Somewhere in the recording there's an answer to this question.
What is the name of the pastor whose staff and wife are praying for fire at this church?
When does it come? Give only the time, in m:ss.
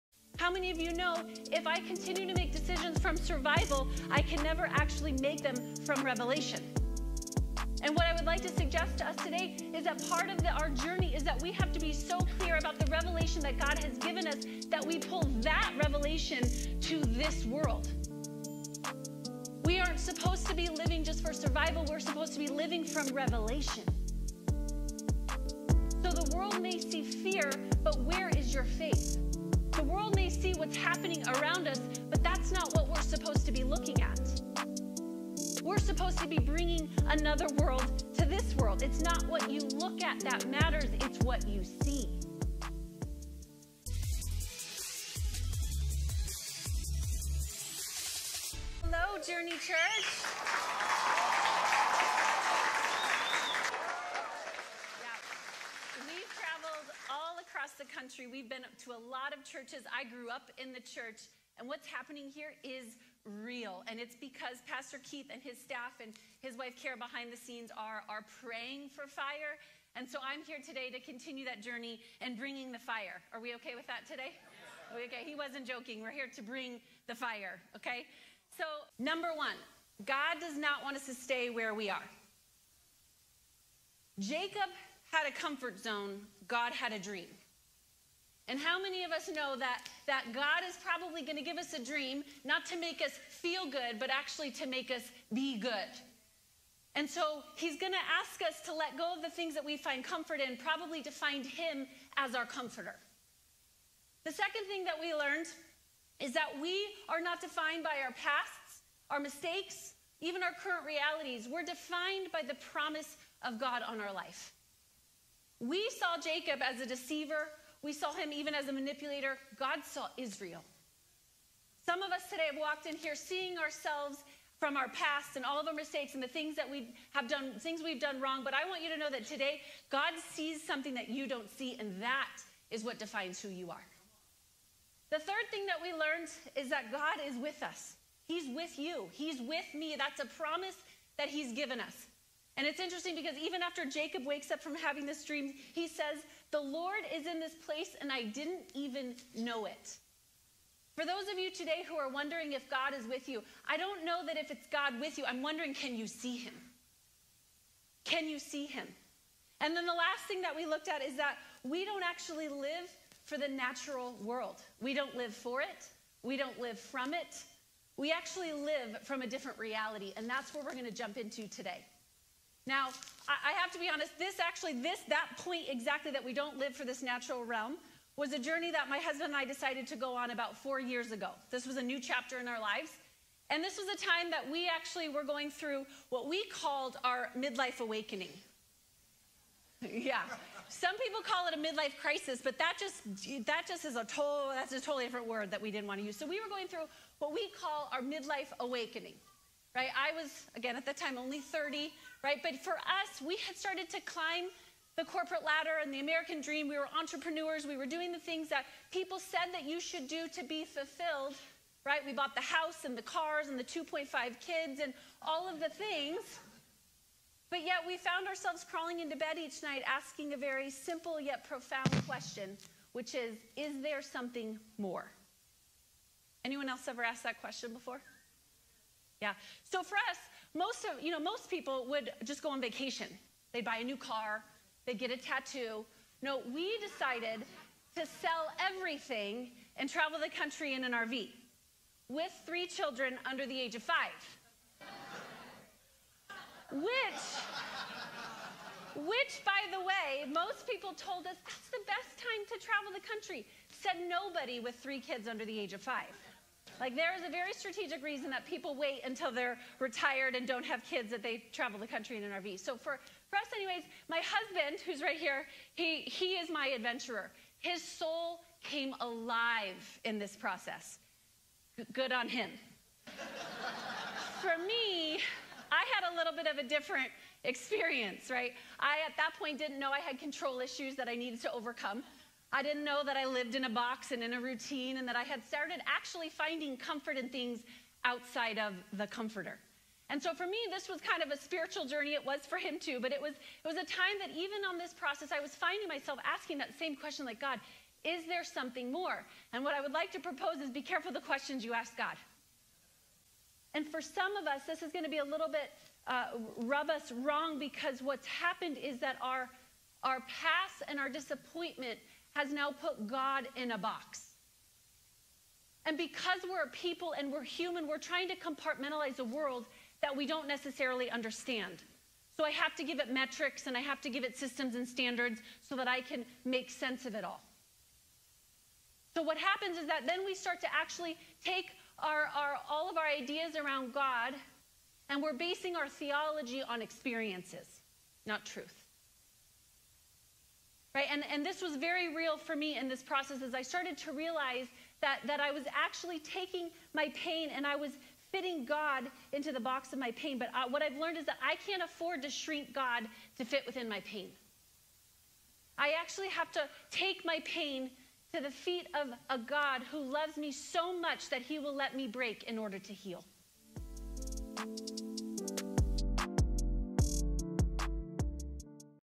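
1:05.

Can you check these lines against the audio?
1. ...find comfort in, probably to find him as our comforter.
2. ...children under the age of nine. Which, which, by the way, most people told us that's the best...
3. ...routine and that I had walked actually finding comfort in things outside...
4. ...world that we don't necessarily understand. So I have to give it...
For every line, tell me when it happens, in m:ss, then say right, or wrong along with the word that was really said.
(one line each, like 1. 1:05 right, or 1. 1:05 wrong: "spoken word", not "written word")
1. 1:39 right
2. 4:02 wrong: "five", not "nine"
3. 4:44 wrong: "started", not "walked"
4. 5:19 right.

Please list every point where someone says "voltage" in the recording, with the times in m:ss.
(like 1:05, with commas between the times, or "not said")
not said.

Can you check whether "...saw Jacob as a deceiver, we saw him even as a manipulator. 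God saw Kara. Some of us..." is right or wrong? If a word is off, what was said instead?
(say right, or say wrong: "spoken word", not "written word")
wrong: "Israel", not "Kara".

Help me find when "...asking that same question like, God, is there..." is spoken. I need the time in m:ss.
4:56.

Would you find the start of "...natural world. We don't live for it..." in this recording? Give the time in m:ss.
2:43.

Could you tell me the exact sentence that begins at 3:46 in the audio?
Anyone else ever asked that question before?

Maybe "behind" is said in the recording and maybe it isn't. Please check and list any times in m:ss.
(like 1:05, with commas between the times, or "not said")
1:06.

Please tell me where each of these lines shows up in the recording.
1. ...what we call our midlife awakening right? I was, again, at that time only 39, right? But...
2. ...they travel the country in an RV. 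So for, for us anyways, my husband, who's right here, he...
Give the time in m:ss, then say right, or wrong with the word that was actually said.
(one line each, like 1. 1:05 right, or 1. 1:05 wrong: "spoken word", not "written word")
1. 3:17 wrong: "30", not "39"
2. 4:21 right.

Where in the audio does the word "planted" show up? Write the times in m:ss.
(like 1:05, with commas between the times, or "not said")
not said.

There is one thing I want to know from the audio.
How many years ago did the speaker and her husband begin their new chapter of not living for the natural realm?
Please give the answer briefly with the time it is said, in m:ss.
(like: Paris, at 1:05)
4, at 3:00.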